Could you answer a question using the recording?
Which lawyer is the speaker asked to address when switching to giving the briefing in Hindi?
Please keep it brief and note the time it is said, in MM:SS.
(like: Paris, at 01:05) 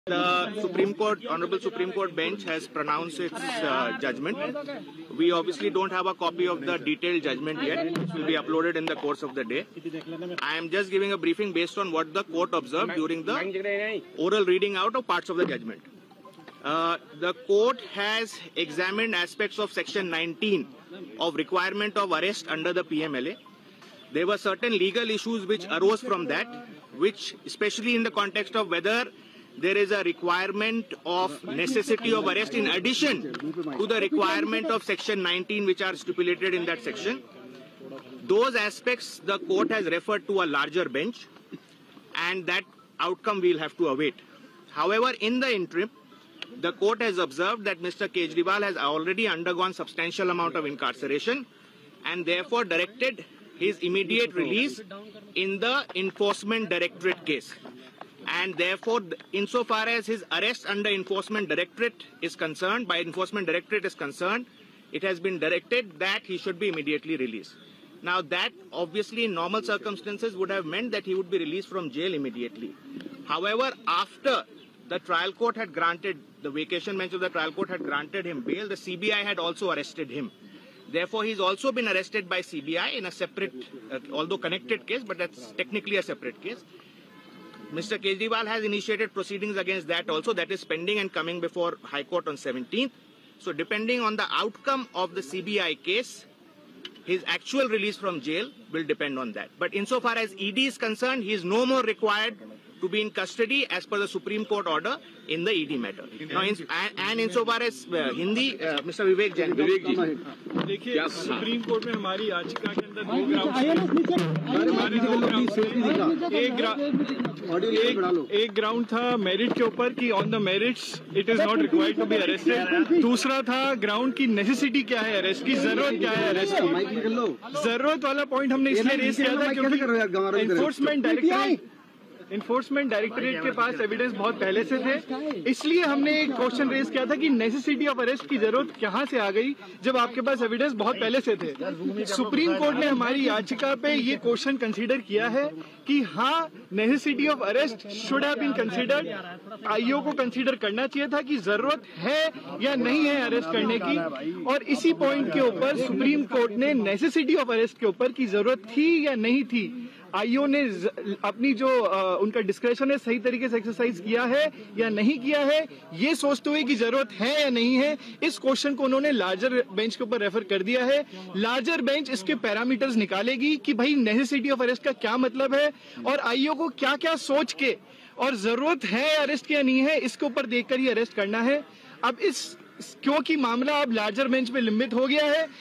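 Vivek Jain, at 01:48.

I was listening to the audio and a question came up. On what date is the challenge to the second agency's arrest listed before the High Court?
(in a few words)
17th.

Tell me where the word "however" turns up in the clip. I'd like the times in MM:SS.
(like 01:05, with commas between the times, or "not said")
00:44, 01:13.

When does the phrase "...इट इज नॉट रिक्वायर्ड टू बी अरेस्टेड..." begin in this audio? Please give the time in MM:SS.
02:01.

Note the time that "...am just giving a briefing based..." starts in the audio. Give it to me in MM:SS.
00:10.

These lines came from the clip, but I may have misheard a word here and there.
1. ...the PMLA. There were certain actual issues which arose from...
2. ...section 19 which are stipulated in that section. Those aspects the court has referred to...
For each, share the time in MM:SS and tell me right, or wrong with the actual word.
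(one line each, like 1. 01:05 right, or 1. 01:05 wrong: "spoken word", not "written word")
1. 00:22 wrong: "legal", not "actual"
2. 00:34 right.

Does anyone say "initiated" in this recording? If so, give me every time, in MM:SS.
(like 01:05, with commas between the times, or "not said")
01:28.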